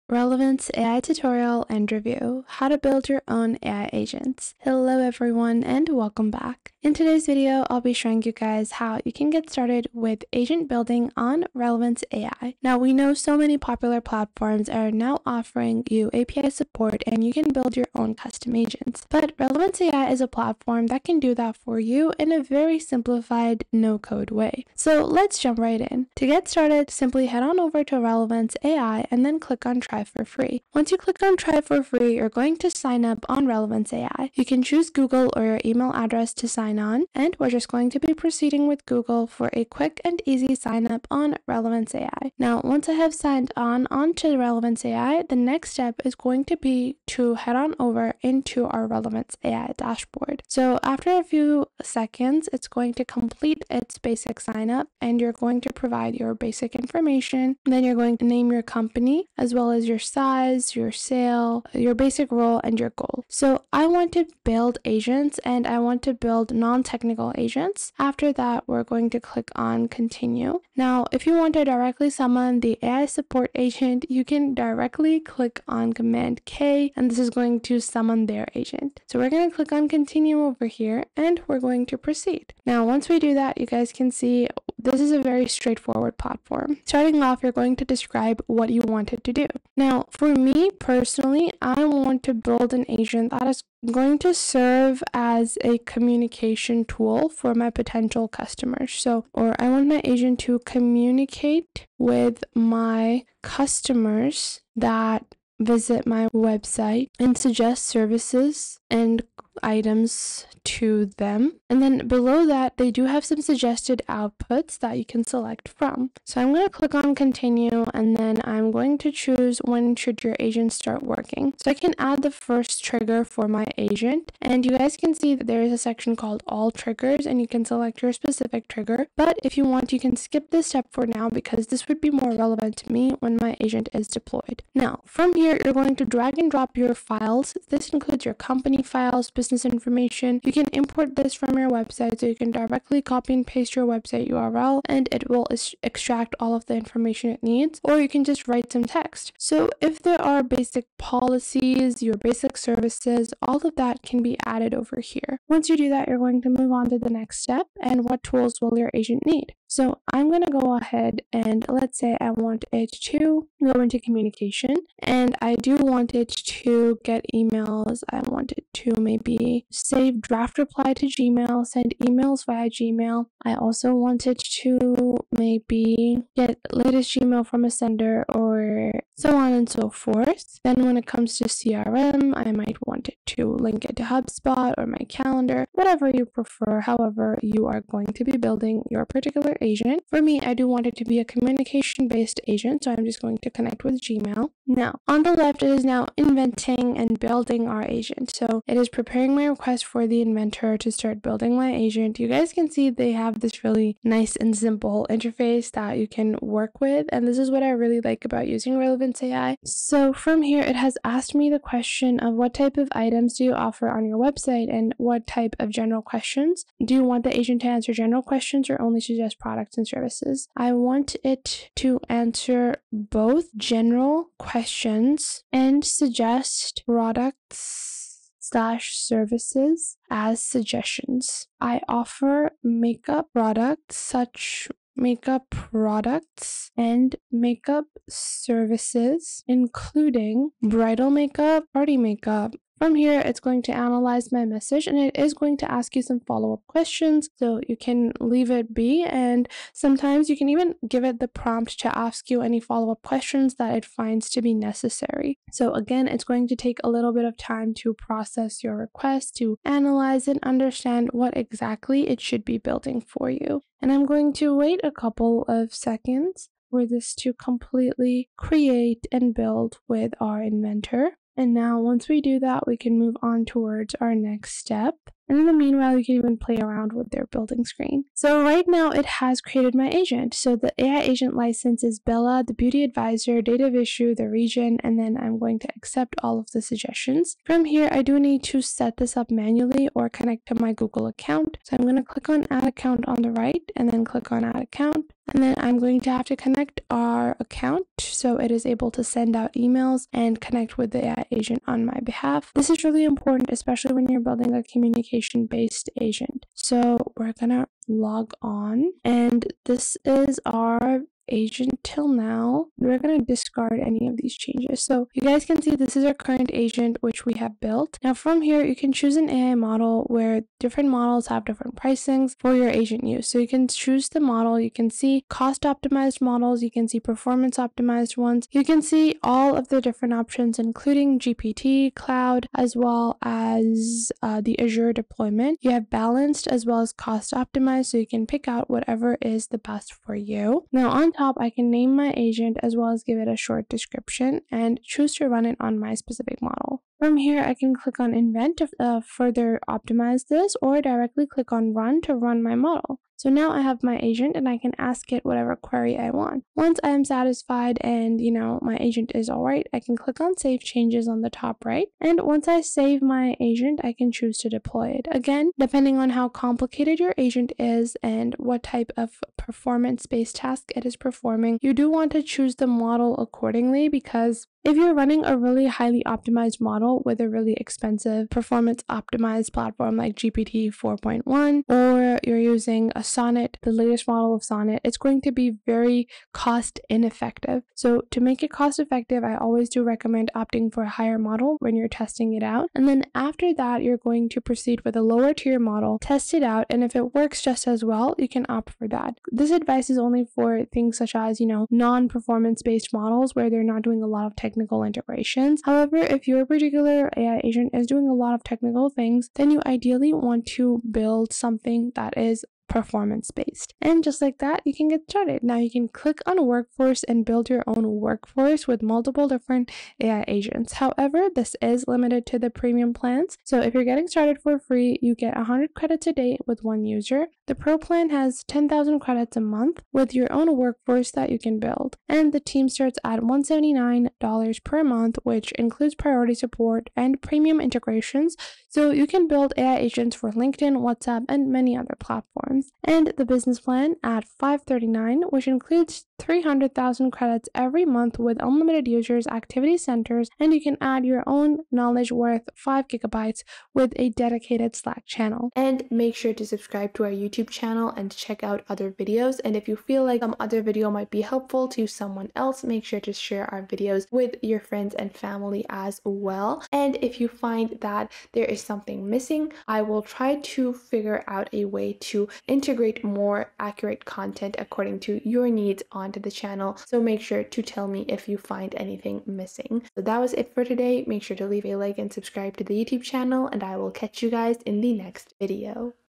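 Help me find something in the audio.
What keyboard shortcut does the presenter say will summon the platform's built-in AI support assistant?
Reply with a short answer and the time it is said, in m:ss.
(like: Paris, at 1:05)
Command K, at 1:15.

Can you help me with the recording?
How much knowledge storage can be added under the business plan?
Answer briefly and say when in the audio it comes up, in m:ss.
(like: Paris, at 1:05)
5 gigabytes, at 7:32.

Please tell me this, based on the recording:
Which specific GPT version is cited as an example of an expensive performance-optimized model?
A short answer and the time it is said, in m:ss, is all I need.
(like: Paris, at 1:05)
GPT 4.1, at 6:20.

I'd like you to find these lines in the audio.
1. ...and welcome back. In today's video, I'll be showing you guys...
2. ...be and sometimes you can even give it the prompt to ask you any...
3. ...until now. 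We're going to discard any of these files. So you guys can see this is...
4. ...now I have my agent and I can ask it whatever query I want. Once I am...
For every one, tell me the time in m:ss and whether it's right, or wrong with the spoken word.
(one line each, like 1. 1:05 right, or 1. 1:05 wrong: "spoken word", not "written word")
1. 0:05 right
2. 4:08 right
3. 5:11 wrong: "changes", not "files"
4. 5:53 right.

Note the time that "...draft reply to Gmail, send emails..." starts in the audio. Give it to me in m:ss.
2:50.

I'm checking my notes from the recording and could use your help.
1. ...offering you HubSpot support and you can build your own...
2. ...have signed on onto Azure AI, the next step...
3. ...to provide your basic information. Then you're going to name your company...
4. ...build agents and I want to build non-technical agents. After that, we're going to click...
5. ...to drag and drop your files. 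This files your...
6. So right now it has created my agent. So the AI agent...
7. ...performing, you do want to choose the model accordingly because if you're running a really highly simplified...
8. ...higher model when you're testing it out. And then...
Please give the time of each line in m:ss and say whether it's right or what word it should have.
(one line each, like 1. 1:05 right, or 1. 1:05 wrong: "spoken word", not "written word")
1. 0:15 wrong: "API", not "HubSpot"
2. 0:42 wrong: "Relevance", not "Azure"
3. 0:55 right
4. 1:04 right
5. 2:15 wrong: "includes", not "files"
6. 4:38 right
7. 6:10 wrong: "optimized", not "simplified"
8. 6:30 right.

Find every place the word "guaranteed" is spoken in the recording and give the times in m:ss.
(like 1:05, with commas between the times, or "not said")
not said.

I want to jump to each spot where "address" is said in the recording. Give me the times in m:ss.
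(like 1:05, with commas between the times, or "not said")
0:35.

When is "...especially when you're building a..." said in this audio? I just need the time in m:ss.
5:03.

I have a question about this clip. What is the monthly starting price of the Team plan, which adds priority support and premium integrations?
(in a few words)
$179.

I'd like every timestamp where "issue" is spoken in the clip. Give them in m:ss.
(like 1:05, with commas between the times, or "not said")
4:43.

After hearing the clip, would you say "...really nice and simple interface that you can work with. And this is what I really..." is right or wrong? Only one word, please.
right.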